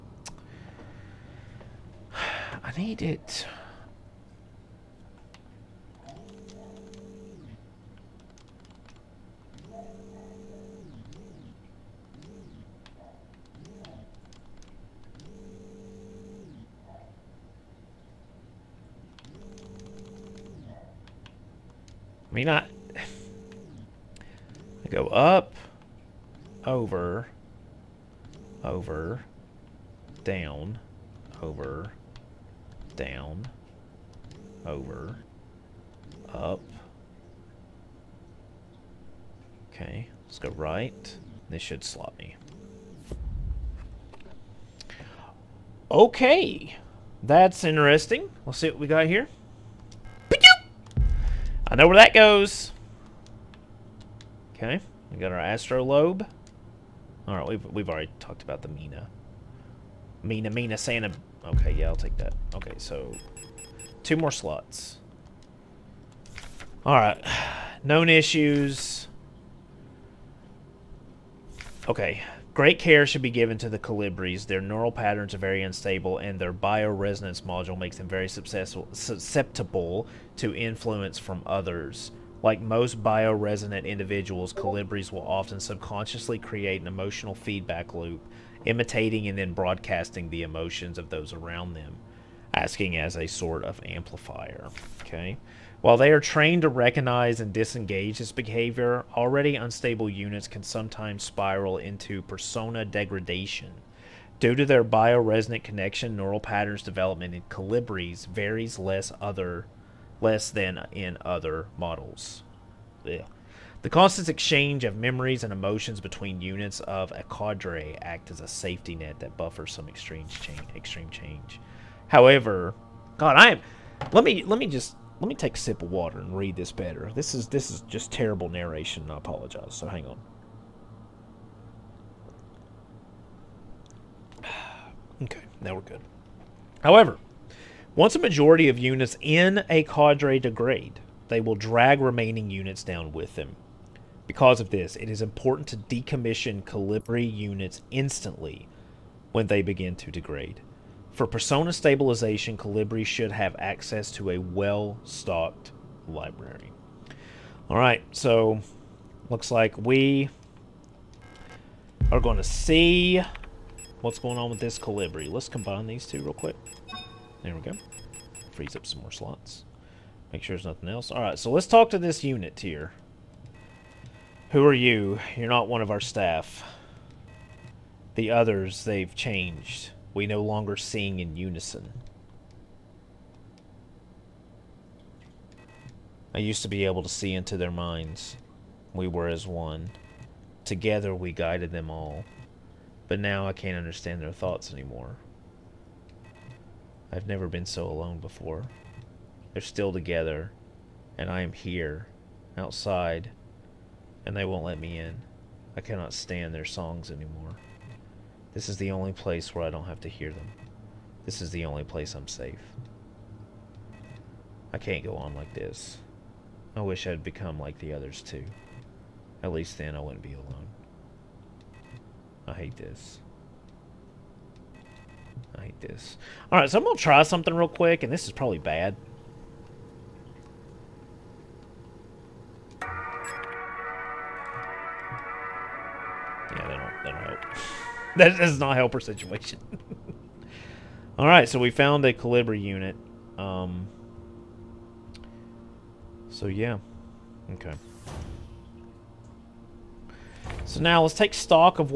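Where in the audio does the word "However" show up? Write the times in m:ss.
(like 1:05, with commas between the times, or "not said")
2:02, 2:16.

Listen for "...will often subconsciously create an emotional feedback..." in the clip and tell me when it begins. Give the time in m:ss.
1:25.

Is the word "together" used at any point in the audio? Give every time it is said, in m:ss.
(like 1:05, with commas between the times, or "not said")
3:10, 3:19.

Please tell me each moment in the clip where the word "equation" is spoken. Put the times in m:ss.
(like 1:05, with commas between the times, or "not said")
not said.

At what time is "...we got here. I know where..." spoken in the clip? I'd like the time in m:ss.
0:48.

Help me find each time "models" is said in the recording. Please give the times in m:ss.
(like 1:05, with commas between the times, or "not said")
1:51.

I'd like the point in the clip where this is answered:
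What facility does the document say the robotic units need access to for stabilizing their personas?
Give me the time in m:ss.
2:34.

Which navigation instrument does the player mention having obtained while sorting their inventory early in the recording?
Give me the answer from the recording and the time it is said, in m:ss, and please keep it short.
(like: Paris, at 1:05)
astrolabe, at 0:55.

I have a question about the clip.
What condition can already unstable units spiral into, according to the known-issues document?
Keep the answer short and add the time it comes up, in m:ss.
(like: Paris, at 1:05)
persona degradation, at 1:42.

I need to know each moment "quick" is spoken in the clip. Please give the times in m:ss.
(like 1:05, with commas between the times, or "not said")
2:46, 3:47.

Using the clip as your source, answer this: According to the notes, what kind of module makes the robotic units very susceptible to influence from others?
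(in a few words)
bioresonance module.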